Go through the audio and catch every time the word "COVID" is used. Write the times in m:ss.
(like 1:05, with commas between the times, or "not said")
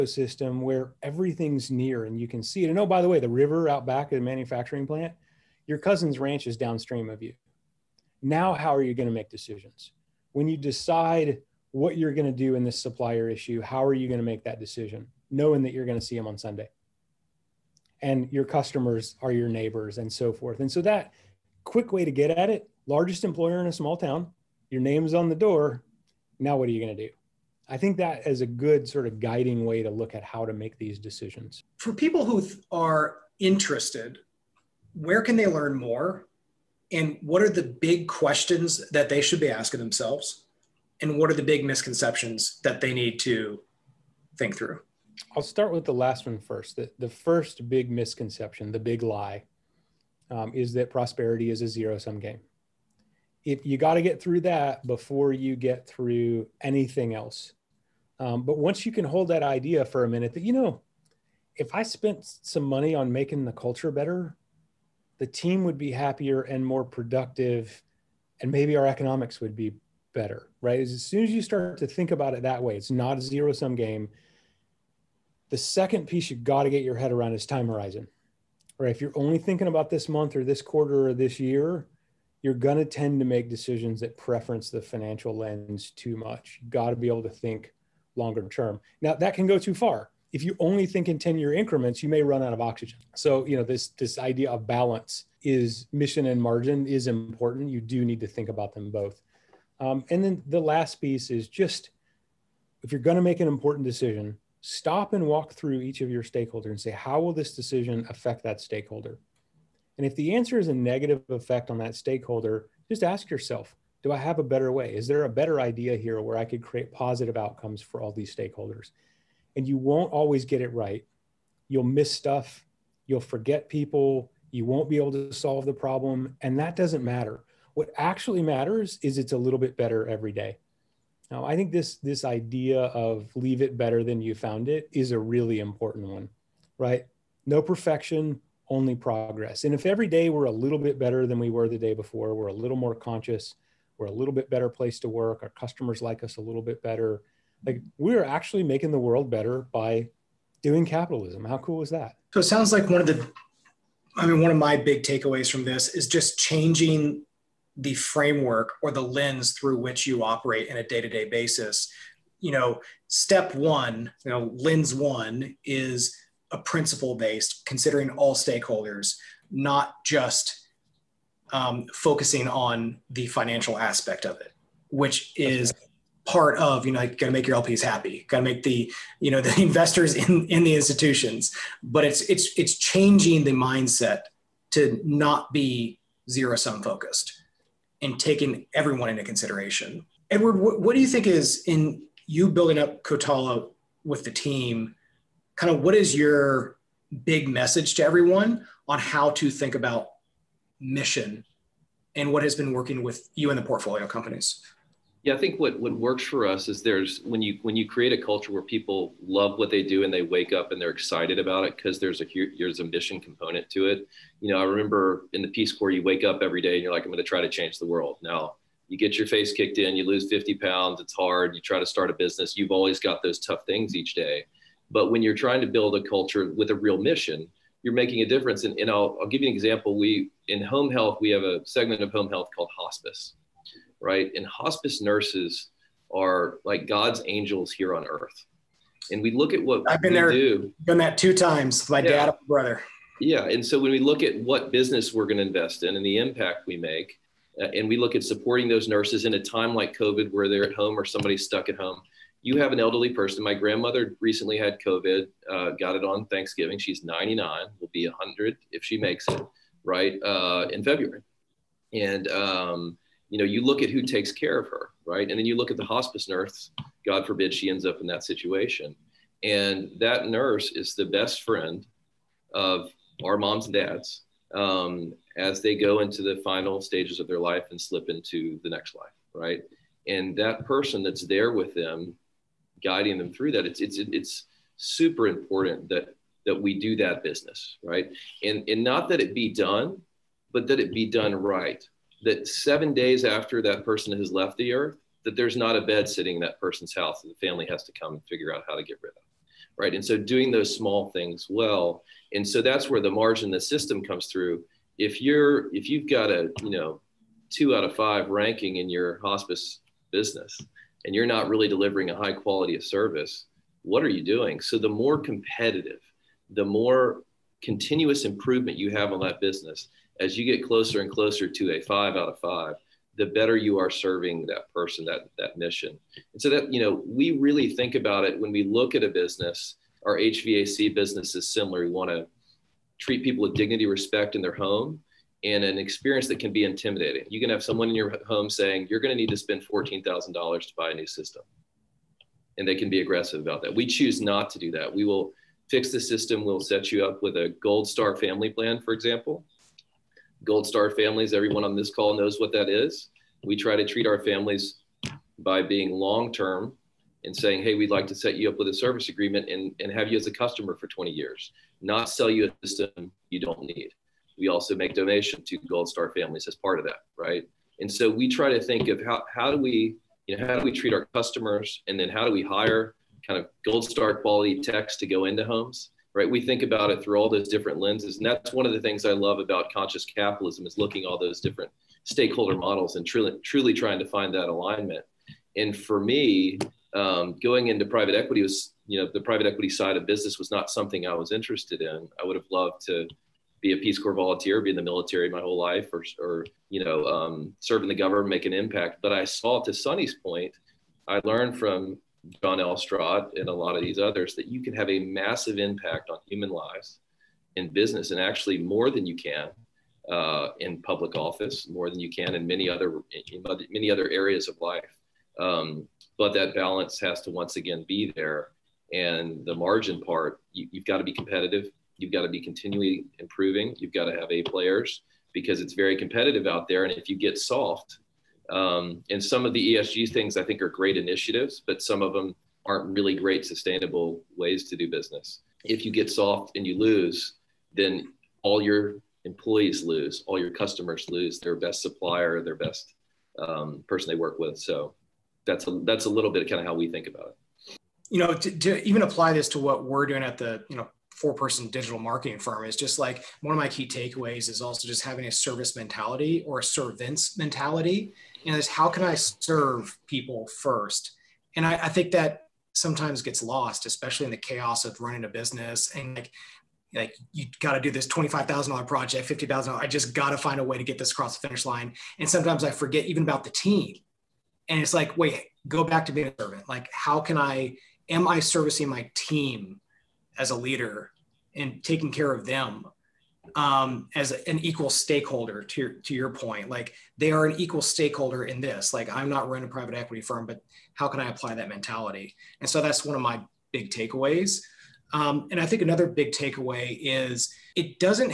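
4:09, 4:14.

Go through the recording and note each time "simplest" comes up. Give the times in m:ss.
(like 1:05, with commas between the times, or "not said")
not said.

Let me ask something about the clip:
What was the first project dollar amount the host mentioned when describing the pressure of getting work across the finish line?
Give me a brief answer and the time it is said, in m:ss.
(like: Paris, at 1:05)
$25,000, at 7:48.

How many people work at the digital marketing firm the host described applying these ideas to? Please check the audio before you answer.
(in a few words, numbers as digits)
4.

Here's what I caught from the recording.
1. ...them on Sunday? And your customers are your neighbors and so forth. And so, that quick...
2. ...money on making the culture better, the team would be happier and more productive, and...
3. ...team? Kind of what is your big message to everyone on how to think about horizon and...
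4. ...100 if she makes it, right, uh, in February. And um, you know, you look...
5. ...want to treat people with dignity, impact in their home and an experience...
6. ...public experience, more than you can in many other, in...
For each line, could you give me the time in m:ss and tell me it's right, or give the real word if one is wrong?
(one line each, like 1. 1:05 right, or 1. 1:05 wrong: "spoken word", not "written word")
1. 0:16 right
2. 1:02 right
3. 3:14 wrong: "mission", not "horizon"
4. 4:18 right
5. 5:31 wrong: "respect", not "impact"
6. 6:50 wrong: "office", not "experience".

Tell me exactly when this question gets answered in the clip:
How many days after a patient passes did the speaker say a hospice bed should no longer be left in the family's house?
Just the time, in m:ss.
4:52.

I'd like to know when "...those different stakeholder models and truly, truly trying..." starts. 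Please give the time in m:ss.
6:21.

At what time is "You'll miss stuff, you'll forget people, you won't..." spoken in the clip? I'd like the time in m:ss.
2:01.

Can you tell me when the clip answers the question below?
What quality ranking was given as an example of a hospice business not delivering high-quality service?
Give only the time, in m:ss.
5:07.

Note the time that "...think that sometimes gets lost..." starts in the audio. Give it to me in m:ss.
7:41.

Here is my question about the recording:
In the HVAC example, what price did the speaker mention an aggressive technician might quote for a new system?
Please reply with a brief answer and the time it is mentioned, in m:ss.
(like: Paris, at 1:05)
$14,000, at 5:39.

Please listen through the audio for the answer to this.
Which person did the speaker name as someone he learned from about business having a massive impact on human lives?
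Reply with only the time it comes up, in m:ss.
6:42.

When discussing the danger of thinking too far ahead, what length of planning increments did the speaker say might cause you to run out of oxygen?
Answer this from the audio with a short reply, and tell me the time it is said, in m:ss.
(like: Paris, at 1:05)
10 year, at 1:31.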